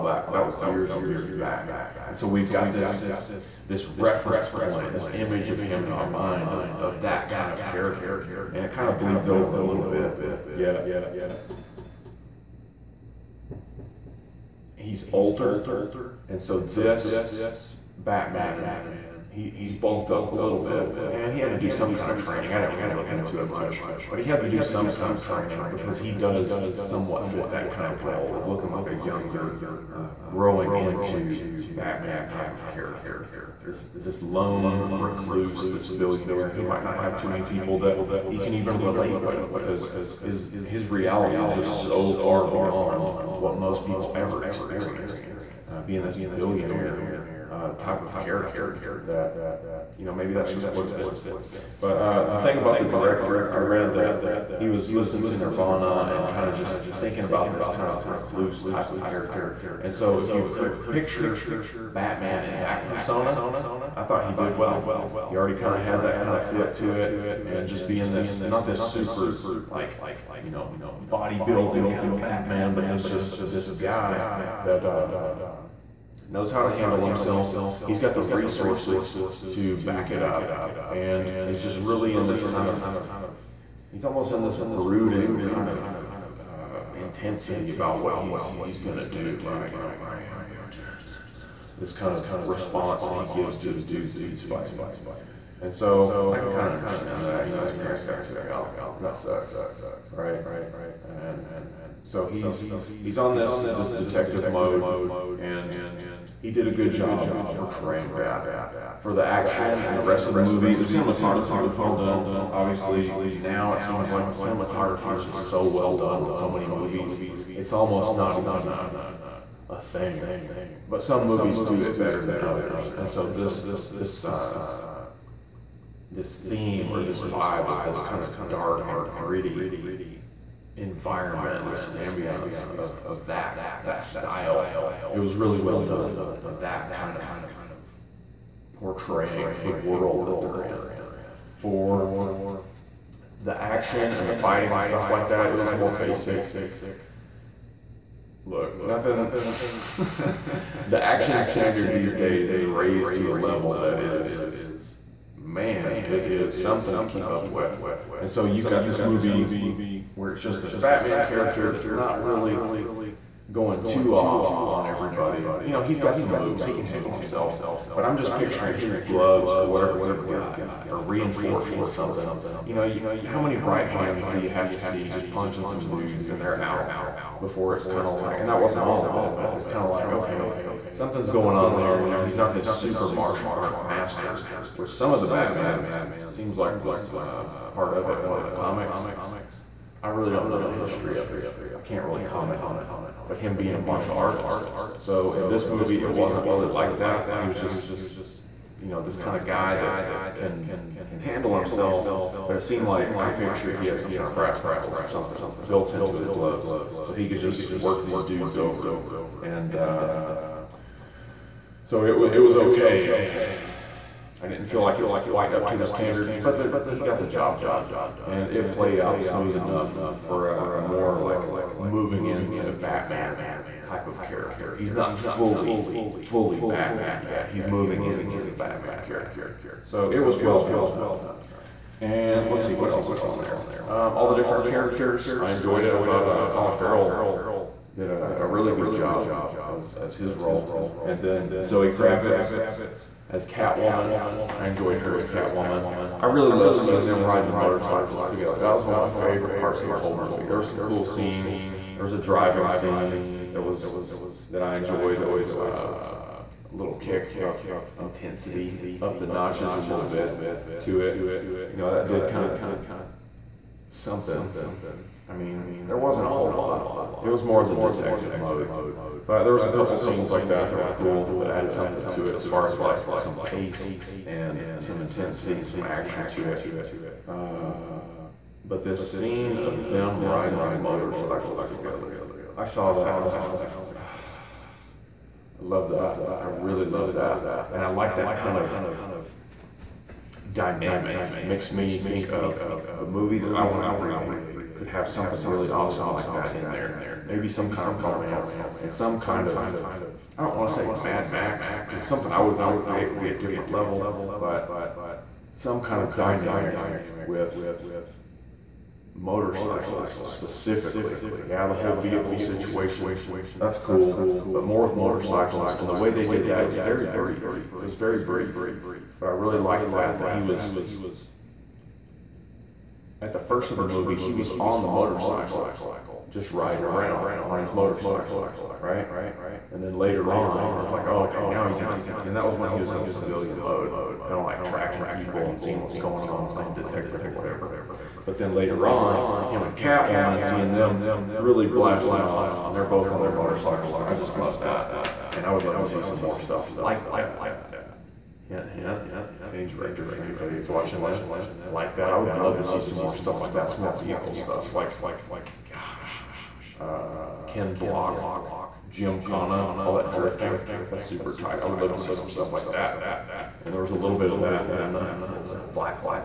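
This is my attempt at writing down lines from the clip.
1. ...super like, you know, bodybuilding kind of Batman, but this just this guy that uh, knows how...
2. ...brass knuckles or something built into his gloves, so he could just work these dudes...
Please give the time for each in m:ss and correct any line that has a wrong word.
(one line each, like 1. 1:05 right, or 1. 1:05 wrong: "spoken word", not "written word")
1. 1:08 right
2. 3:24 right.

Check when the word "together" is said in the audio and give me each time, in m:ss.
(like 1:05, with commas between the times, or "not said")
4:08, 4:41.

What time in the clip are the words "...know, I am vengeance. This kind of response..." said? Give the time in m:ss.
1:29.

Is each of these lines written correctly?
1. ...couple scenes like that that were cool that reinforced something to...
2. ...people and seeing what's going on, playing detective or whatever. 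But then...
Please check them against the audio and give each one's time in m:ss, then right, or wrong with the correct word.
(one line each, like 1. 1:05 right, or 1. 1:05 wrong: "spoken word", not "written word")
1. 4:29 wrong: "added", not "reinforced"
2. 5:35 right.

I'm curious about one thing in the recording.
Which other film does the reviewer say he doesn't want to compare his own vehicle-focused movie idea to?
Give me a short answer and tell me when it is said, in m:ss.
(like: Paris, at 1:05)
Mad Max, at 5:00.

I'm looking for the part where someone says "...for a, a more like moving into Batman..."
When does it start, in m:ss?
3:40.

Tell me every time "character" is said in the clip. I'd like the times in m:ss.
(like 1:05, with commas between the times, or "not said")
0:07, 0:32, 0:48, 0:59, 2:41, 3:44, 3:49, 3:54.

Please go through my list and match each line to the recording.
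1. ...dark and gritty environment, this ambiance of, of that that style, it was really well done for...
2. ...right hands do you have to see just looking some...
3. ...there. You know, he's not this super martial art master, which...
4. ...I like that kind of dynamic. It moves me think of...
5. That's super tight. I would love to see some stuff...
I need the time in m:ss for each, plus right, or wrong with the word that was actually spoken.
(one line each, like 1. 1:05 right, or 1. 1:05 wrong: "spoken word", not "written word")
1. 2:08 right
2. 2:53 wrong: "punching", not "looking"
3. 3:01 right
4. 4:47 wrong: "makes", not "moves"
5. 6:00 right.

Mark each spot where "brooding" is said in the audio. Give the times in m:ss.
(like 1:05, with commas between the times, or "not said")
1:24.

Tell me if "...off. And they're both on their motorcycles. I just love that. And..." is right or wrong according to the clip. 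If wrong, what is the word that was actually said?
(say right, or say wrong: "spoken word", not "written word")
right.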